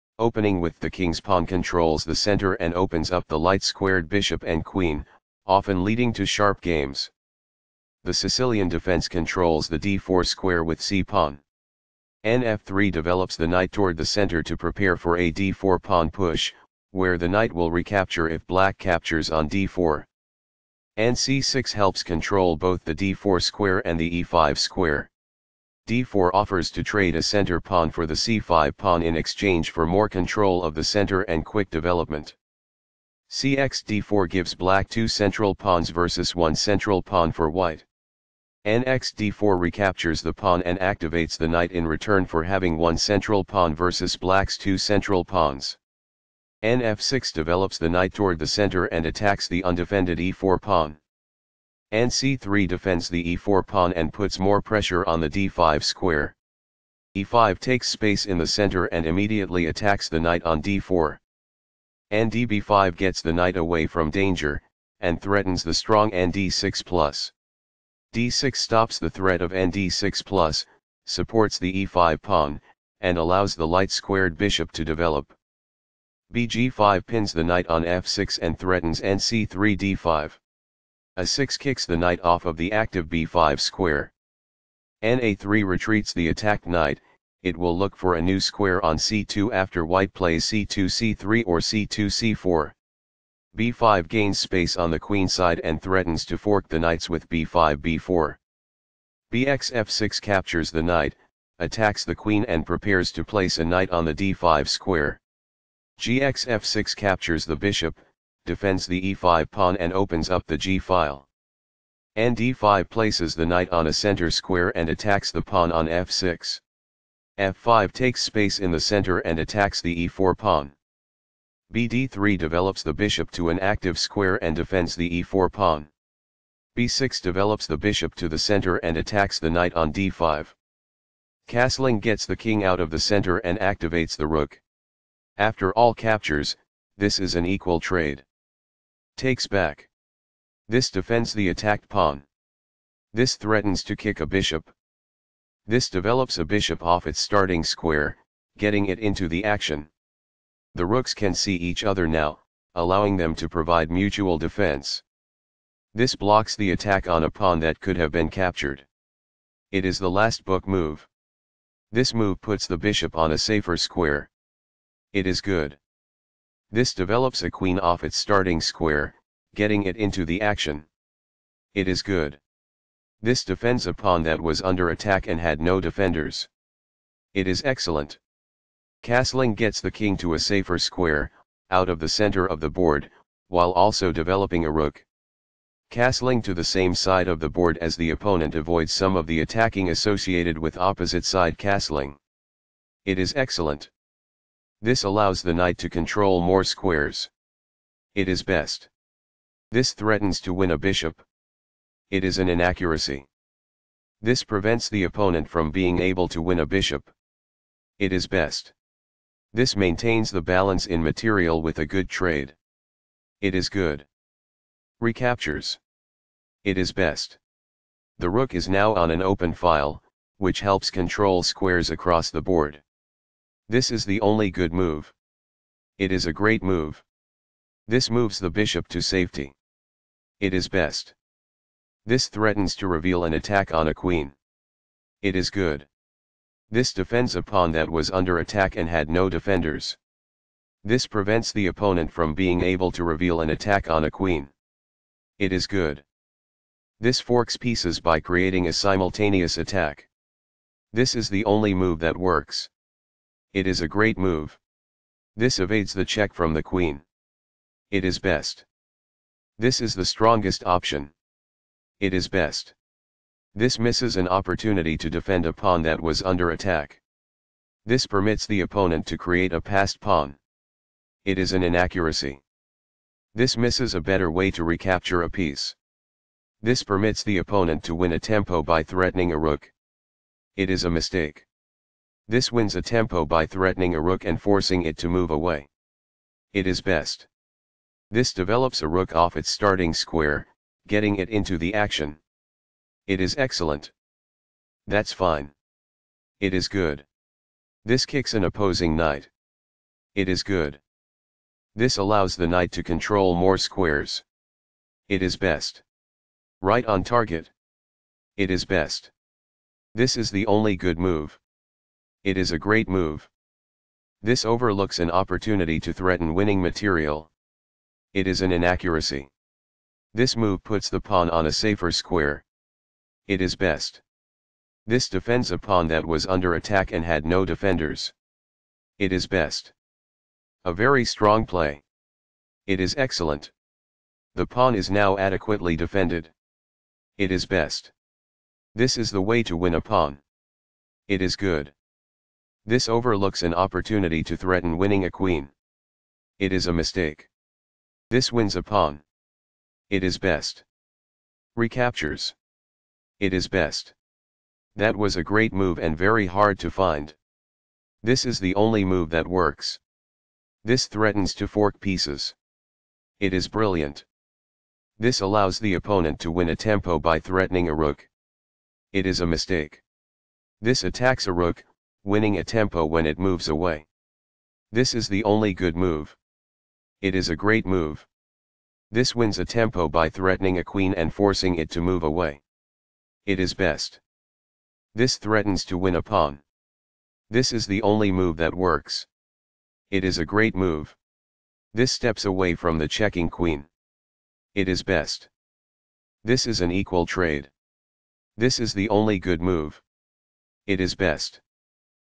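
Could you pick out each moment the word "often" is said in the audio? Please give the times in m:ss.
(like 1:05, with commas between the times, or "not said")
0:05.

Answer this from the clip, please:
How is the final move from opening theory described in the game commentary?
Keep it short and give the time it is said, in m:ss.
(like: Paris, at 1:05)
last book move, at 2:39.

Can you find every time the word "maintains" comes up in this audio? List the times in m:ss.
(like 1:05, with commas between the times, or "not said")
3:29.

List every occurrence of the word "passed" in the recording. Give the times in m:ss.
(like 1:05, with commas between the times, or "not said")
4:29.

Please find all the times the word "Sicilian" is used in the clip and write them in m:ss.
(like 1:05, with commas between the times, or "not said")
0:08.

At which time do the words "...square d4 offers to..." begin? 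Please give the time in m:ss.
0:24.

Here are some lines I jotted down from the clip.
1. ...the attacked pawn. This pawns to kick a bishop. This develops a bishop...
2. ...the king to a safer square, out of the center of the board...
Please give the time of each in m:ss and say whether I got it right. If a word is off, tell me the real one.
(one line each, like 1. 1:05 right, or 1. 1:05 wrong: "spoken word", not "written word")
1. 2:21 wrong: "threatens", not "pawns"
2. 2:59 right.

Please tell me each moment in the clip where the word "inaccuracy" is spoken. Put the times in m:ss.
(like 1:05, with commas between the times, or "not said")
3:22, 4:31, 5:18.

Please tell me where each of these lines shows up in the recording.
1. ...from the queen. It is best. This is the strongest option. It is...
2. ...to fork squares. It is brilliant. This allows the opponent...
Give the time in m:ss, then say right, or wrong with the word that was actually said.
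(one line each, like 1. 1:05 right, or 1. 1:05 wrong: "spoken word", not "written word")
1. 4:16 right
2. 6:01 wrong: "pieces", not "squares".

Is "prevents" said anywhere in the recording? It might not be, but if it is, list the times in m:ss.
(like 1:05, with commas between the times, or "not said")
3:24, 4:01.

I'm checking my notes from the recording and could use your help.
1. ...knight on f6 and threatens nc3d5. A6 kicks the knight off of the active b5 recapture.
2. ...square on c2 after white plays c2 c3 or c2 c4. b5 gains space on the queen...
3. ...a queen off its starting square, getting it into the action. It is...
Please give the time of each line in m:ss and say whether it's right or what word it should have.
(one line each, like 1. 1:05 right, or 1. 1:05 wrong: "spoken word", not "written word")
1. 1:17 wrong: "square", not "recapture"
2. 1:28 right
3. 2:47 right.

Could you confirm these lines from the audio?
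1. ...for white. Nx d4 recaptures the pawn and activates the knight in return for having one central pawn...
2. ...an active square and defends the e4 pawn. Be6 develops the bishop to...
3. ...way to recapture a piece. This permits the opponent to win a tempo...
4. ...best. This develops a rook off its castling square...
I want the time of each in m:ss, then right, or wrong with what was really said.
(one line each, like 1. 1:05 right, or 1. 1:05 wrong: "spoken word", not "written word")
1. 0:37 right
2. 2:03 right
3. 4:34 right
4. 4:46 wrong: "starting", not "castling".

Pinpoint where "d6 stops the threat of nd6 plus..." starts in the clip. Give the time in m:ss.
1:08.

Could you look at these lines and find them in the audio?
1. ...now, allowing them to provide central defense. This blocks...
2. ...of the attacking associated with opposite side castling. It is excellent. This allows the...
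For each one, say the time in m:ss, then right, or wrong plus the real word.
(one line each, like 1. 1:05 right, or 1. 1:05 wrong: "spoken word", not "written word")
1. 2:32 wrong: "mutual", not "central"
2. 3:09 right.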